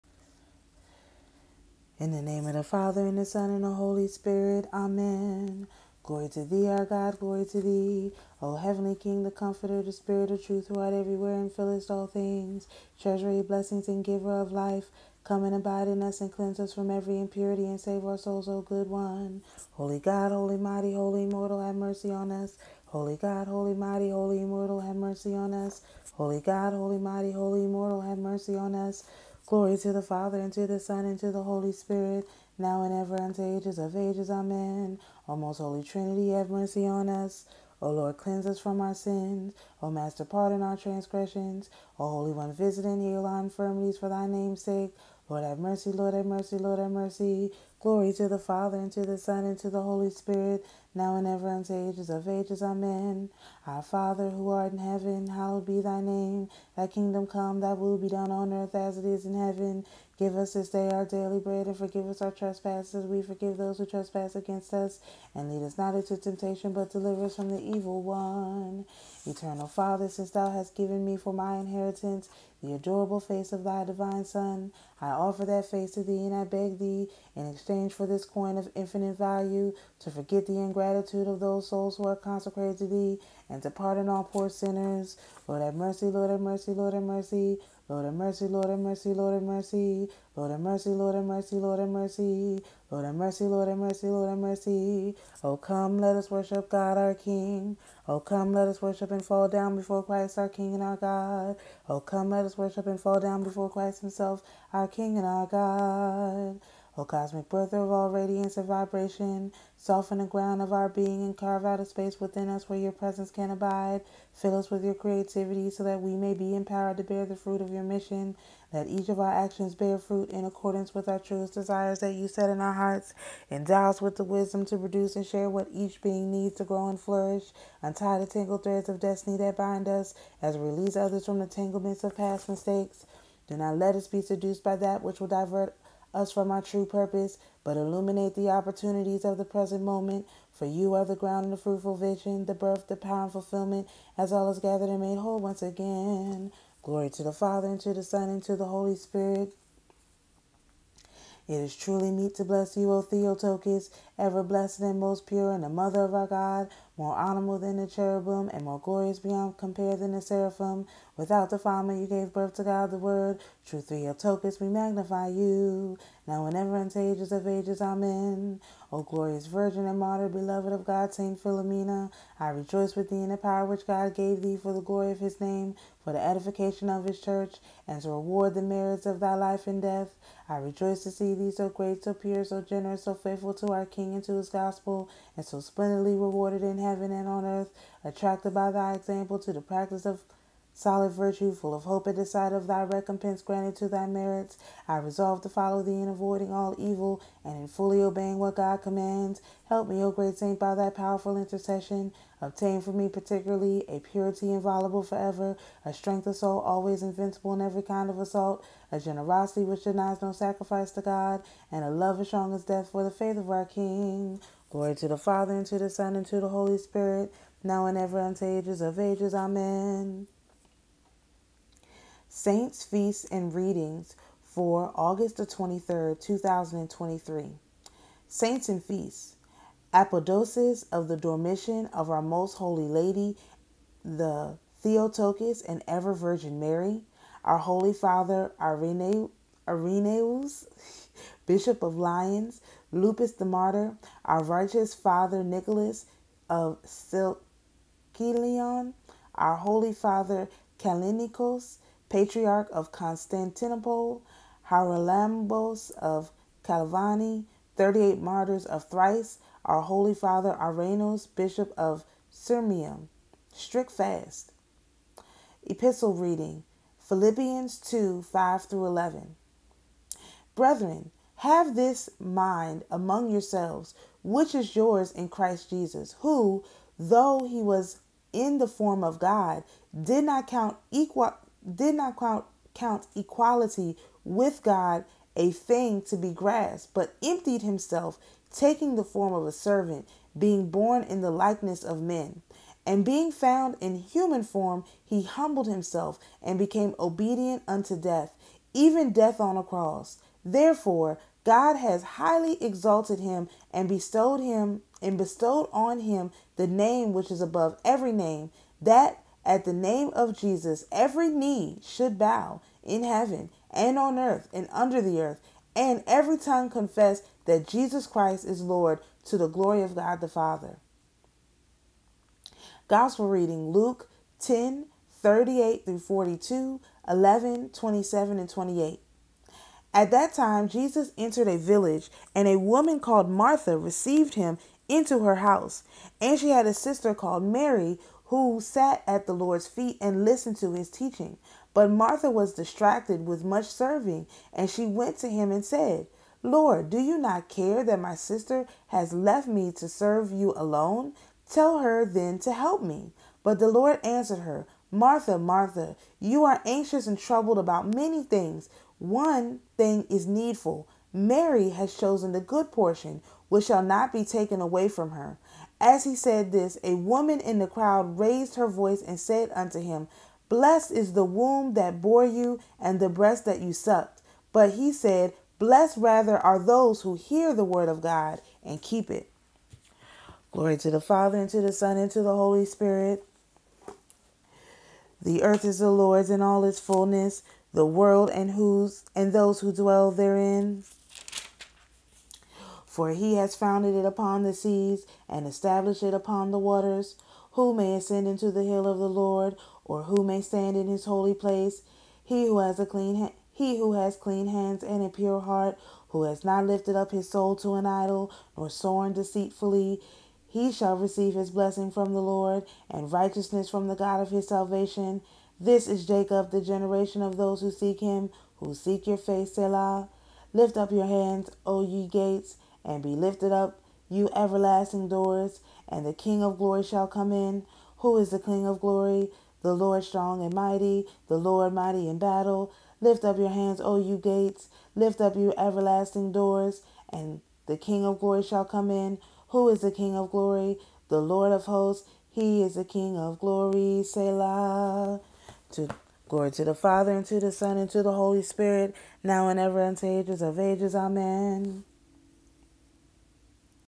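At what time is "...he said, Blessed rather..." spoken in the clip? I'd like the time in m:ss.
6:14.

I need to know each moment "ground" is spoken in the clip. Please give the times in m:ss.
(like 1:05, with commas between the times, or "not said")
1:50, 2:21.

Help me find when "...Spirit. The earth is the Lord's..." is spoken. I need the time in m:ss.
6:22.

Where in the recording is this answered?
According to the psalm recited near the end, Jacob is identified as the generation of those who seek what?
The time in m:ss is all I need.
6:58.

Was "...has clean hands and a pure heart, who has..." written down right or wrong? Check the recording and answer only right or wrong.
right.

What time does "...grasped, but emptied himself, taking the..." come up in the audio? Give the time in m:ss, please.
4:46.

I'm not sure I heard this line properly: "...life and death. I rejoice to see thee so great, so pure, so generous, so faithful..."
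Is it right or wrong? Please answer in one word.
right.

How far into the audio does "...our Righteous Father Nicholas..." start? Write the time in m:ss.
4:04.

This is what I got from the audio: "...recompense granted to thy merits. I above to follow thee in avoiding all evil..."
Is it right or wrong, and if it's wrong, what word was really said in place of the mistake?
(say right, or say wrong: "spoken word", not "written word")
wrong: "resolve", not "above".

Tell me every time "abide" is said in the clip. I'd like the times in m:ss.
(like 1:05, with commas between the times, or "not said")
0:15, 1:53.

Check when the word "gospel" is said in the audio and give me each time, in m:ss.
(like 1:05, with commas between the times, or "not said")
3:04, 5:22.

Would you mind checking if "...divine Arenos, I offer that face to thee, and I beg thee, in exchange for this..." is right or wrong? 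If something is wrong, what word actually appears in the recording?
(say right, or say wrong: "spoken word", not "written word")
wrong: "Son", not "Arenos".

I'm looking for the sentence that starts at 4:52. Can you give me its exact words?
And being found in human form, he humbled himself and became obedient unto death, even death on a cross.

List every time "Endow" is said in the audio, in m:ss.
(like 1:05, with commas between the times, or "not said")
2:03.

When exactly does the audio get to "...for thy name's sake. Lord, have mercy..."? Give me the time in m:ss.
0:43.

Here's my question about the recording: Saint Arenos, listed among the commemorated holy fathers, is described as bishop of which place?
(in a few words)
Sirmium.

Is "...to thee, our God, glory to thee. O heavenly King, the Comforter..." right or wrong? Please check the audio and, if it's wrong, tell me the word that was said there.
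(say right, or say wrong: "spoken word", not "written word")
right.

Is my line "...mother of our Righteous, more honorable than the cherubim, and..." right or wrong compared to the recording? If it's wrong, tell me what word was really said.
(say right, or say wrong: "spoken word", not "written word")
wrong: "God", not "Righteous".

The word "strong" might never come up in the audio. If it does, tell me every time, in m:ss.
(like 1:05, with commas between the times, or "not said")
3:32, 7:10.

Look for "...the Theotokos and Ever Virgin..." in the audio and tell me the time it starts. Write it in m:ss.
3:54.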